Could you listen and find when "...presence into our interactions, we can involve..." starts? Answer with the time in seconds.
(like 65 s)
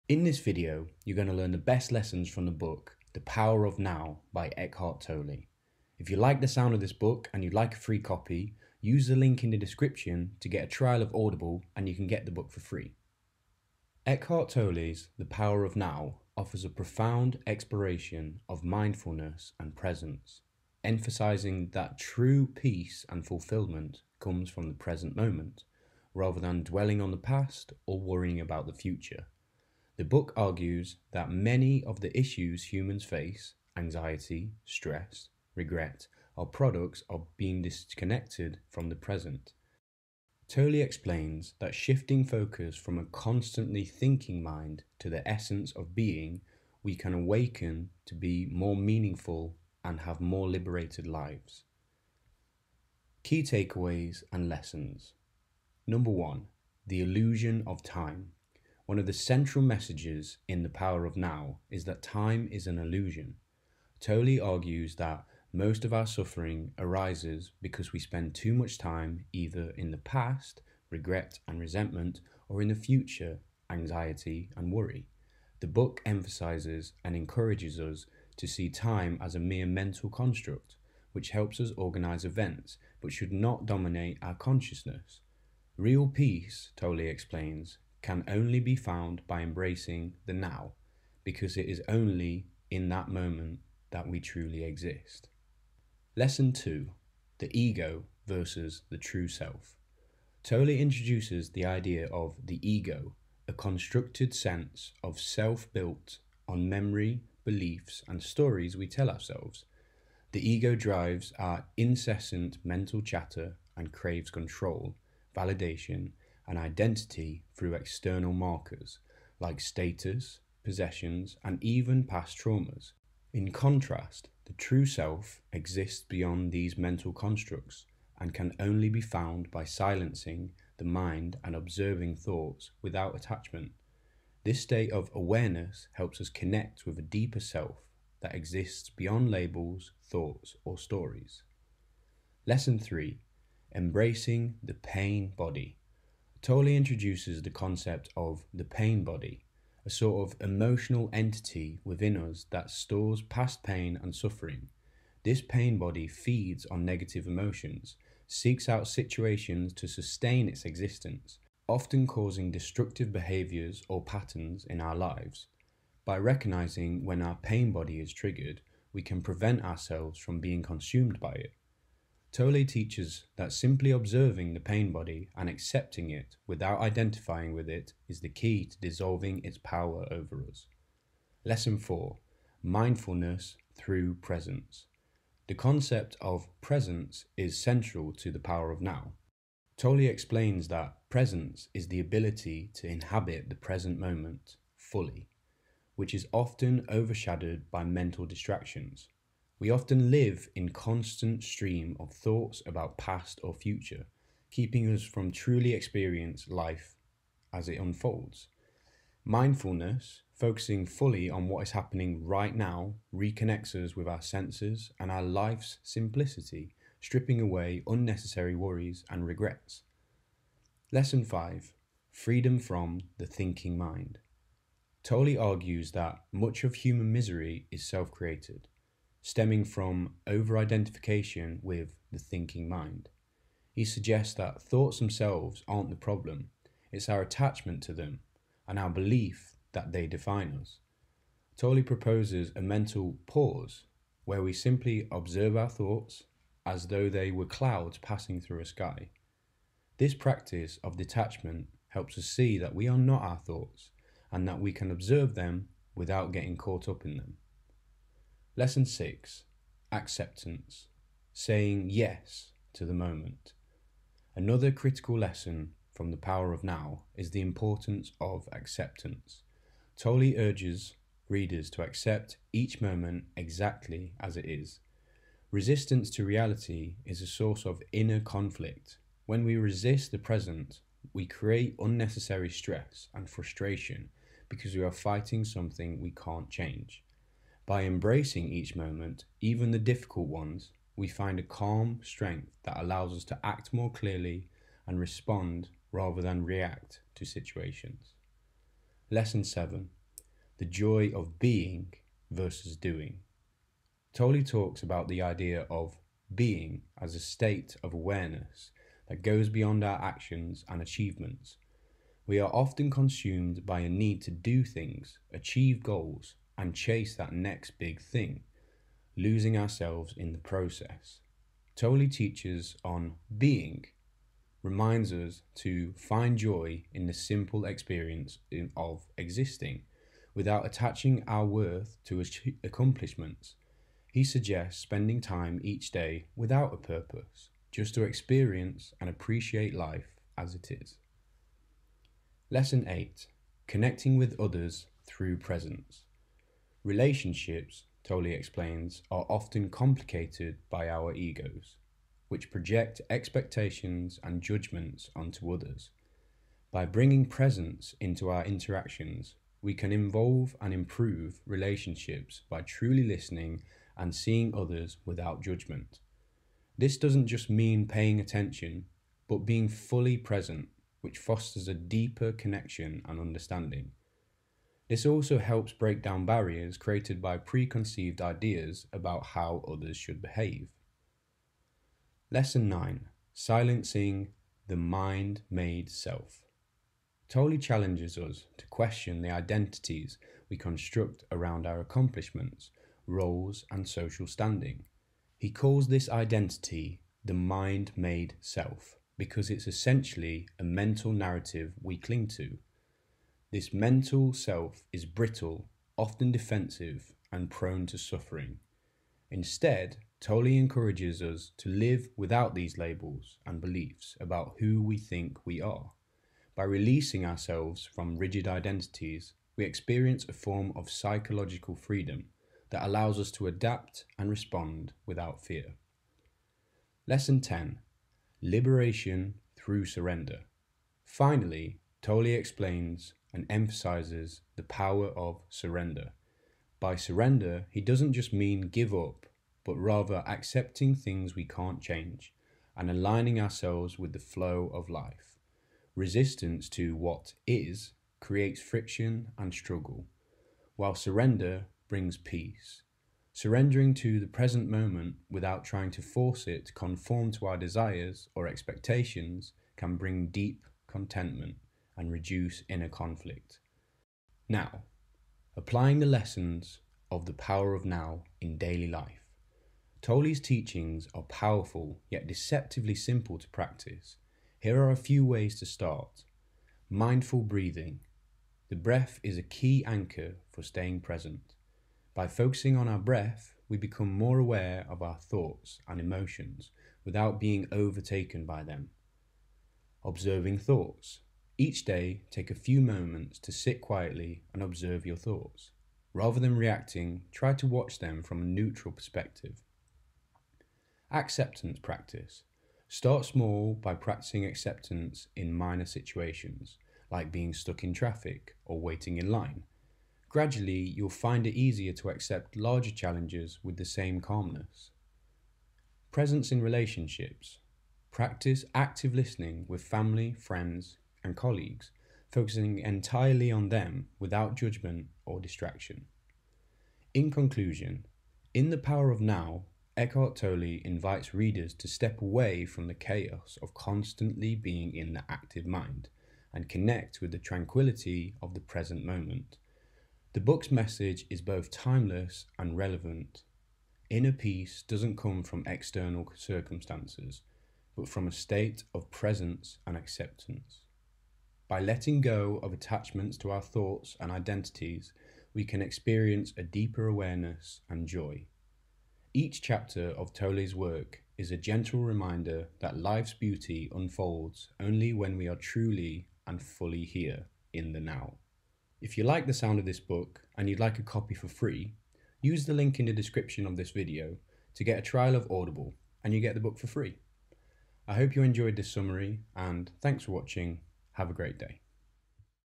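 357 s.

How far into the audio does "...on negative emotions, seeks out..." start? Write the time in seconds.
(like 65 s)
156 s.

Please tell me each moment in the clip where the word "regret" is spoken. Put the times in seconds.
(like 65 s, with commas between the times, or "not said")
35 s, 70 s, 219 s.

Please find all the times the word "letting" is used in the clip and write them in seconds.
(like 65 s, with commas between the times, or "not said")
551 s.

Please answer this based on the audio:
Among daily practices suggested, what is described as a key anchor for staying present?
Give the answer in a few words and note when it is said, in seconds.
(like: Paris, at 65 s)
The breath, at 478 s.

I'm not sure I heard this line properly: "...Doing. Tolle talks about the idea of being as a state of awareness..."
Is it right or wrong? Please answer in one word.
right.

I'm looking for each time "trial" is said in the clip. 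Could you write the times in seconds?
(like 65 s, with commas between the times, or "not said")
10 s, 575 s.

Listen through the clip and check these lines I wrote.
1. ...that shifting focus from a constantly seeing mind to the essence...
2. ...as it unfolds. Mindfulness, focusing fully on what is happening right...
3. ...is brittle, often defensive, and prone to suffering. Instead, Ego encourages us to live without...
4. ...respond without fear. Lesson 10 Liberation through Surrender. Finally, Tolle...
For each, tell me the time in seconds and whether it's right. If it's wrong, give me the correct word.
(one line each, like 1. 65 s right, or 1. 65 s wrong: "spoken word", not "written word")
1. 41 s wrong: "thinking", not "seeing"
2. 207 s right
3. 404 s wrong: "Tolle", not "Ego"
4. 424 s right.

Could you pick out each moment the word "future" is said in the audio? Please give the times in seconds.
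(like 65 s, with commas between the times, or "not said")
28 s, 72 s, 203 s.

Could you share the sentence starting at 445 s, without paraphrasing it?
Resistance to what is creates friction and struggle, while surrender brings peace.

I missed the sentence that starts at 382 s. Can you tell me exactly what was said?
Lesson 9 Silencing the Mind Made Self.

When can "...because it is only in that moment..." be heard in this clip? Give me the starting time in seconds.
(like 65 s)
91 s.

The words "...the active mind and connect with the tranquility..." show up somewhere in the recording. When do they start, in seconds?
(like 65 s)
535 s.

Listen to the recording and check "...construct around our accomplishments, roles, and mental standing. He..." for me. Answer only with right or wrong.
wrong.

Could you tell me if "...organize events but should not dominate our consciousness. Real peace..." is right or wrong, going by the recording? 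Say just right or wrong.
right.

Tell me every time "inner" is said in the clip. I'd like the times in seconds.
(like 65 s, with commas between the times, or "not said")
277 s, 462 s, 544 s.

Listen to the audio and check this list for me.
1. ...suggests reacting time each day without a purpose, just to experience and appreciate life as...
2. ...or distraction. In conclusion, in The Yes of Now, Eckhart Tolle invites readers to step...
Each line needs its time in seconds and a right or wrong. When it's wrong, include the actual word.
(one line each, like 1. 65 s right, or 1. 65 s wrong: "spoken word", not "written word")
1. 334 s wrong: "spending", not "reacting"
2. 525 s wrong: "Power", not "Yes".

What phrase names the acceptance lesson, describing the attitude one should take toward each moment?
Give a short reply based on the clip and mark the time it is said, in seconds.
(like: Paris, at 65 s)
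Saying Yes to the Moment, at 261 s.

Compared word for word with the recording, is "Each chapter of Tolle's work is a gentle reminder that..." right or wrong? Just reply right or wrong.
right.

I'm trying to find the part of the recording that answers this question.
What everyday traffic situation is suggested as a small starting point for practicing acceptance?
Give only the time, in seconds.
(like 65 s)
507 s.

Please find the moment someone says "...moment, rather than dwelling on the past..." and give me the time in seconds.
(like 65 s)
25 s.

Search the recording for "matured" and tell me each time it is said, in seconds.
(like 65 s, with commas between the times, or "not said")
not said.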